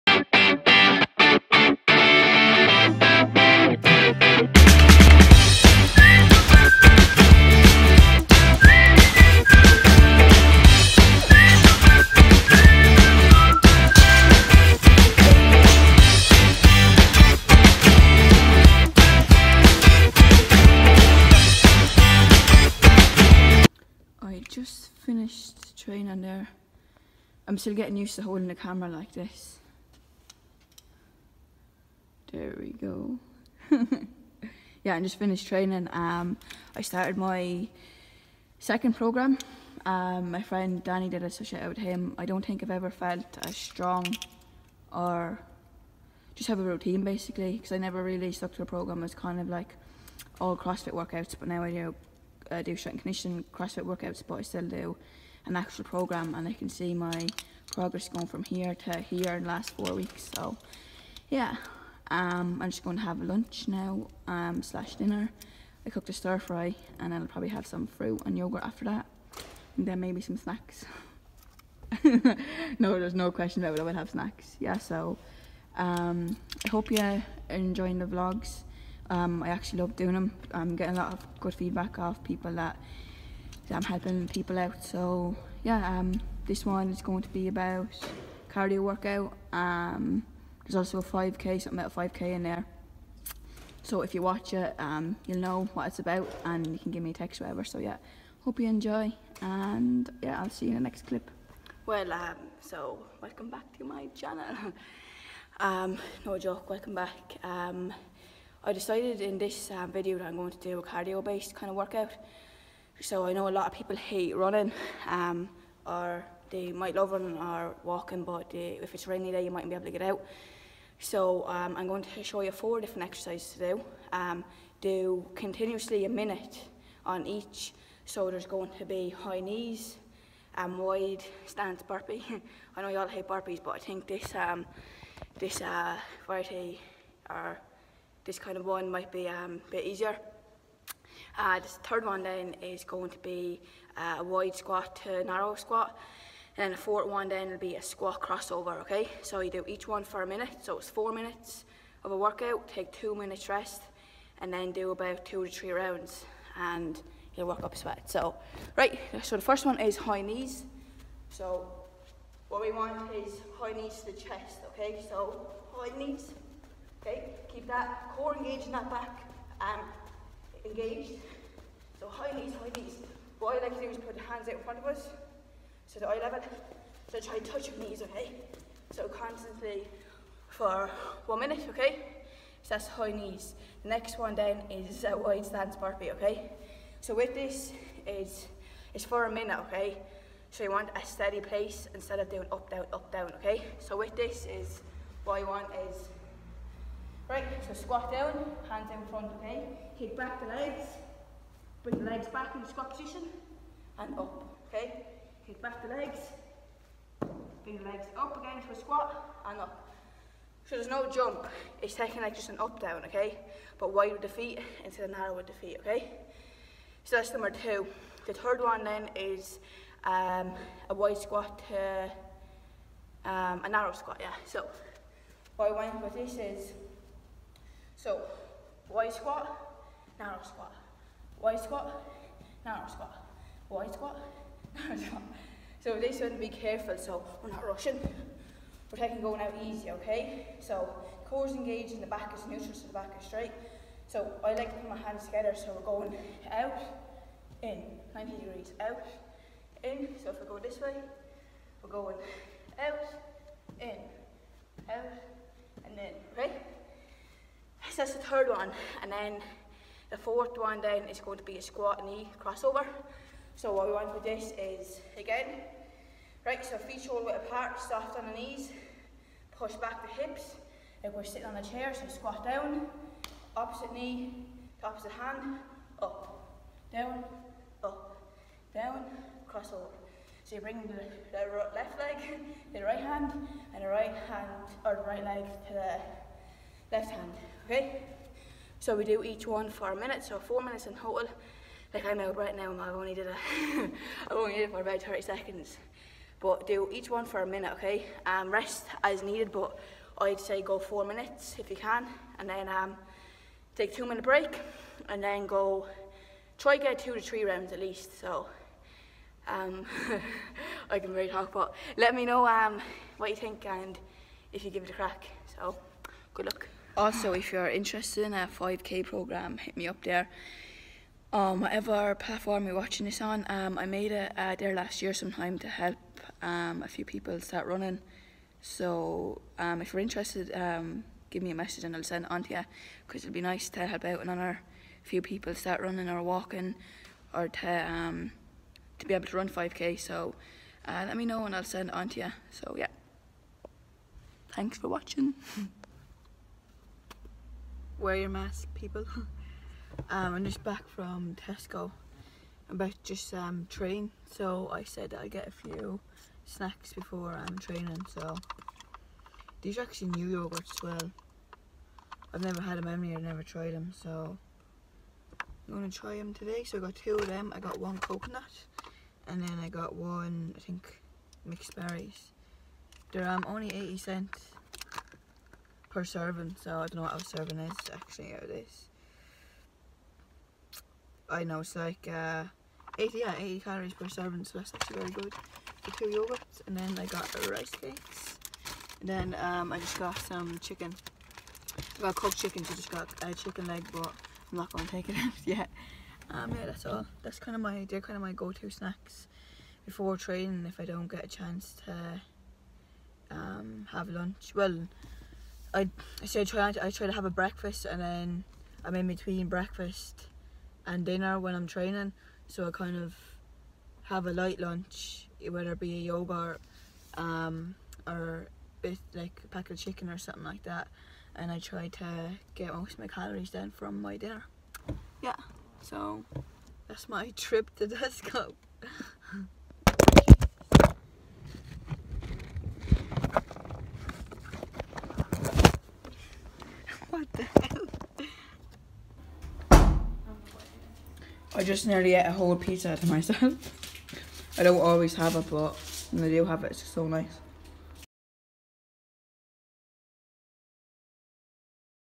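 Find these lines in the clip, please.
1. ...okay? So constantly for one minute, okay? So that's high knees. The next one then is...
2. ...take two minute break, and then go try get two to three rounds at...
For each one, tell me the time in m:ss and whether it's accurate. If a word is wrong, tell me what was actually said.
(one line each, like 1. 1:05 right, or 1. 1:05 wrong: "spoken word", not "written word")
1. 2:58 right
2. 5:03 right.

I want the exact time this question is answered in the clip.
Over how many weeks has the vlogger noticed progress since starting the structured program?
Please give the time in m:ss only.
0:59.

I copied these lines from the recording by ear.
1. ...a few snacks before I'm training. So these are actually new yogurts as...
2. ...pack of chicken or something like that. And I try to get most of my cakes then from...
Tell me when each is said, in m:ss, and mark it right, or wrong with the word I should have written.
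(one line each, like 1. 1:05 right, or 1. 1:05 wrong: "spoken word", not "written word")
1. 5:55 right
2. 6:59 wrong: "calories", not "cakes".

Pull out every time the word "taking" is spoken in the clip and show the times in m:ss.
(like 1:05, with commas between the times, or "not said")
3:31, 3:58.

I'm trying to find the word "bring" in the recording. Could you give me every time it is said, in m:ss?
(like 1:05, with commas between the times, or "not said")
3:21, 3:27, 4:40.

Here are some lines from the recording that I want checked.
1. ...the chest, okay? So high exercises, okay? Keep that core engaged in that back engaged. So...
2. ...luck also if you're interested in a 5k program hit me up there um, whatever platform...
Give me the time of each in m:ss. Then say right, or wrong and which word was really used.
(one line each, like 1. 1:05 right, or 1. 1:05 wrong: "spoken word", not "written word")
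1. 2:44 wrong: "knees", not "exercises"
2. 5:16 right.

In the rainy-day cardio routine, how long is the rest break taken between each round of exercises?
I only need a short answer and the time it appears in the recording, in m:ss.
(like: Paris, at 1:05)
2 minutes, at 2:32.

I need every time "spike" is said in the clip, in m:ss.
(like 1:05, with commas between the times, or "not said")
not said.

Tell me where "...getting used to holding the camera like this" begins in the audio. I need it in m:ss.
0:27.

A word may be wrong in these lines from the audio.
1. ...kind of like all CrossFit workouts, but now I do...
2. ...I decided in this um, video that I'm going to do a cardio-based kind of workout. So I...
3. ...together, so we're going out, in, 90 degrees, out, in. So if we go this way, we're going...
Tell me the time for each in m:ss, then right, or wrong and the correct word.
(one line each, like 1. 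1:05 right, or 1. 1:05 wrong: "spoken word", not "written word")
1. 0:49 right
2. 1:48 right
3. 4:05 right.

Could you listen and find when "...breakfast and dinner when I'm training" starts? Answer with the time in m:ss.
6:49.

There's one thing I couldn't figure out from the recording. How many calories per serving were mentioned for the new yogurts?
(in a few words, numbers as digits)
80.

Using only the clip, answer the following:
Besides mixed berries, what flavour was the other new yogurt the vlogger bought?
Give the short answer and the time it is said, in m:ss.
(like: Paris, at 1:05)
Coconut, at 6:07.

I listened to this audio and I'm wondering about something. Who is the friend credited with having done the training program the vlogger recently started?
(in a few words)
Danny.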